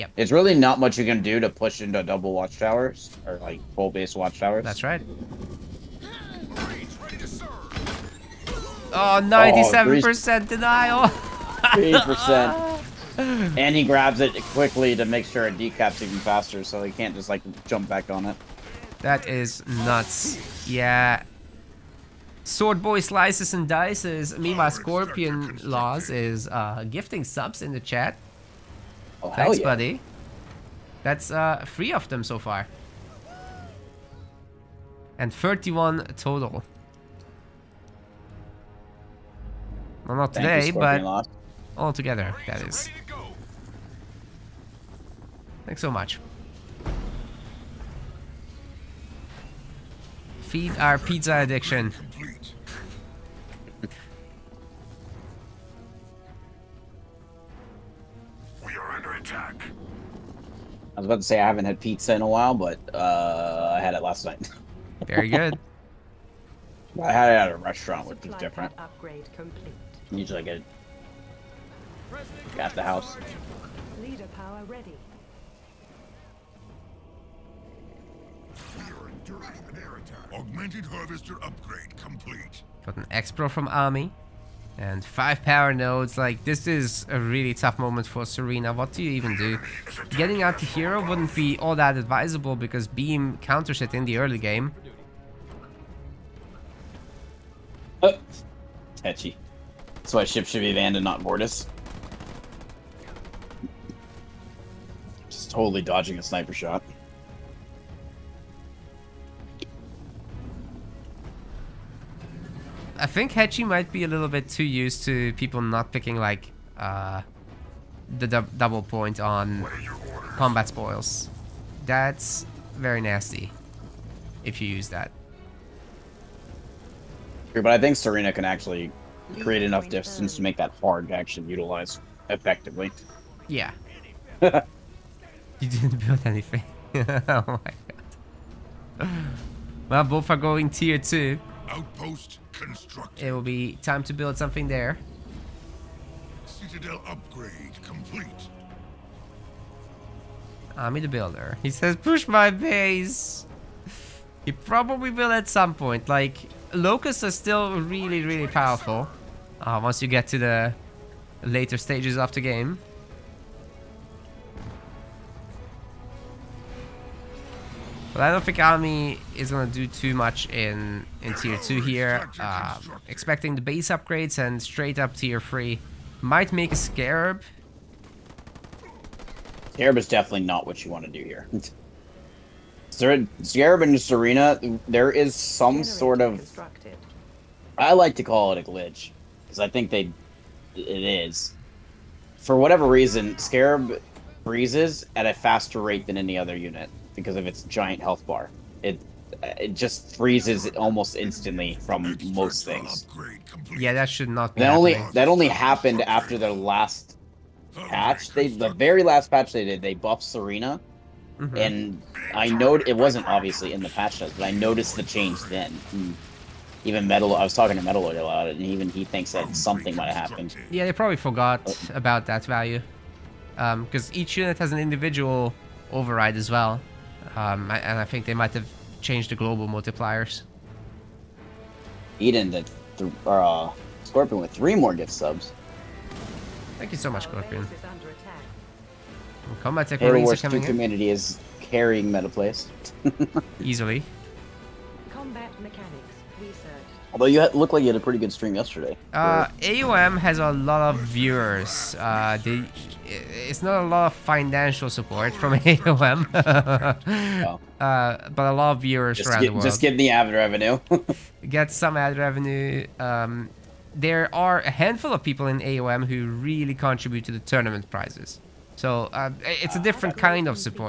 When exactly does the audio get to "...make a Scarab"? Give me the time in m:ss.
2:56.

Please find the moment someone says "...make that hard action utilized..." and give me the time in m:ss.
2:10.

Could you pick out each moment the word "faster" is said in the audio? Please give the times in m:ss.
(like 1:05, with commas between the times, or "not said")
0:16, 3:15.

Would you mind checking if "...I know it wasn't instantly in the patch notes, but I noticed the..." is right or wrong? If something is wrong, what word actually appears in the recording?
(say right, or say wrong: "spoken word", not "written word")
wrong: "obviously", not "instantly".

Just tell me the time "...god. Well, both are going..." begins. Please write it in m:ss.
2:17.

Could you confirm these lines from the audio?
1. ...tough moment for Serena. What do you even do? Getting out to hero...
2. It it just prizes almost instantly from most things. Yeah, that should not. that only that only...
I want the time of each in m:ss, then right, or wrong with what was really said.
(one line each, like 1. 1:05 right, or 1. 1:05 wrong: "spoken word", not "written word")
1. 1:27 right
2. 3:18 wrong: "freezes", not "prizes".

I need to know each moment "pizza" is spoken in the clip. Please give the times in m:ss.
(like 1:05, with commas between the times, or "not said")
0:50, 1:01.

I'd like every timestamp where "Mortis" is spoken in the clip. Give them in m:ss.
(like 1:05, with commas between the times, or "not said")
1:41.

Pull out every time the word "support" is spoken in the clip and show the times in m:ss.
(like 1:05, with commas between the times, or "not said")
4:14.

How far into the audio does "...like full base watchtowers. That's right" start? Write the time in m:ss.
0:03.